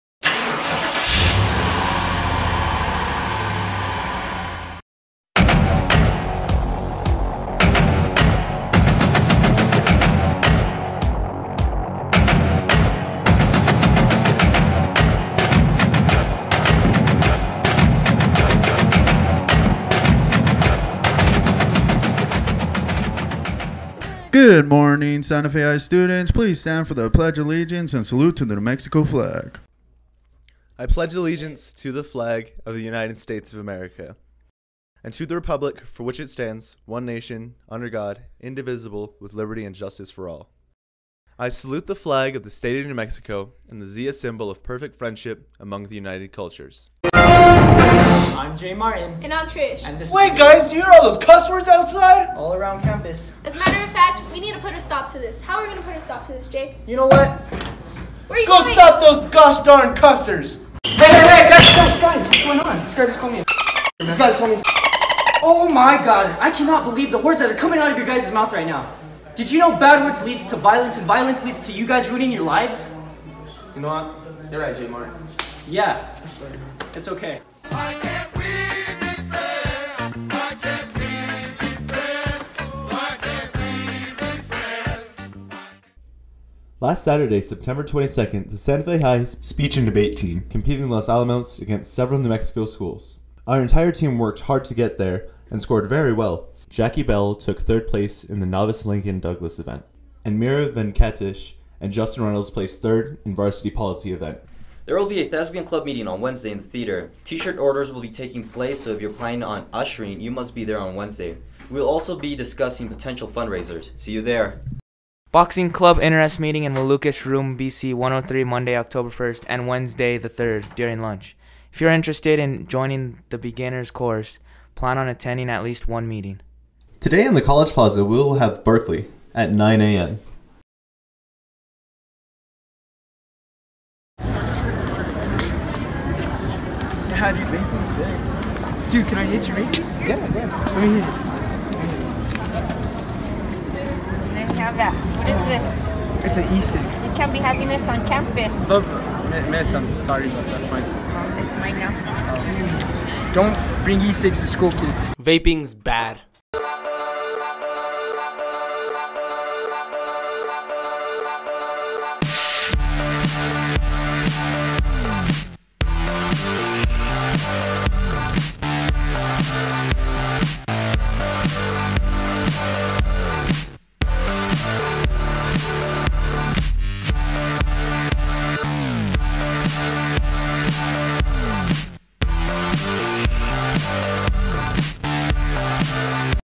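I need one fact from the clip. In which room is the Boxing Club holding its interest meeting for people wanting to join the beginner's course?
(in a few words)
BC 103.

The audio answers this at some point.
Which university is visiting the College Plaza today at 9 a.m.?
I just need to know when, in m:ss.
2:08.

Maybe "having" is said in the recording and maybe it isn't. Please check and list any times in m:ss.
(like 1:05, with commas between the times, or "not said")
2:27.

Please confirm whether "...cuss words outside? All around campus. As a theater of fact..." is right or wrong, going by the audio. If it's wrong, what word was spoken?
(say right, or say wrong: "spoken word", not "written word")
wrong: "matter", not "theater".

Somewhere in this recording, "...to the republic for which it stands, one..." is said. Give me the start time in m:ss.
0:35.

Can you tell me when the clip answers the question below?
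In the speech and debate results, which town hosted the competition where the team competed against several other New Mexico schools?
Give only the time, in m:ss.
1:30.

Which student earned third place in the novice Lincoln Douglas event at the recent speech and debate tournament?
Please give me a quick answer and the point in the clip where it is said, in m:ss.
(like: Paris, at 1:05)
Jackie Bell, at 1:36.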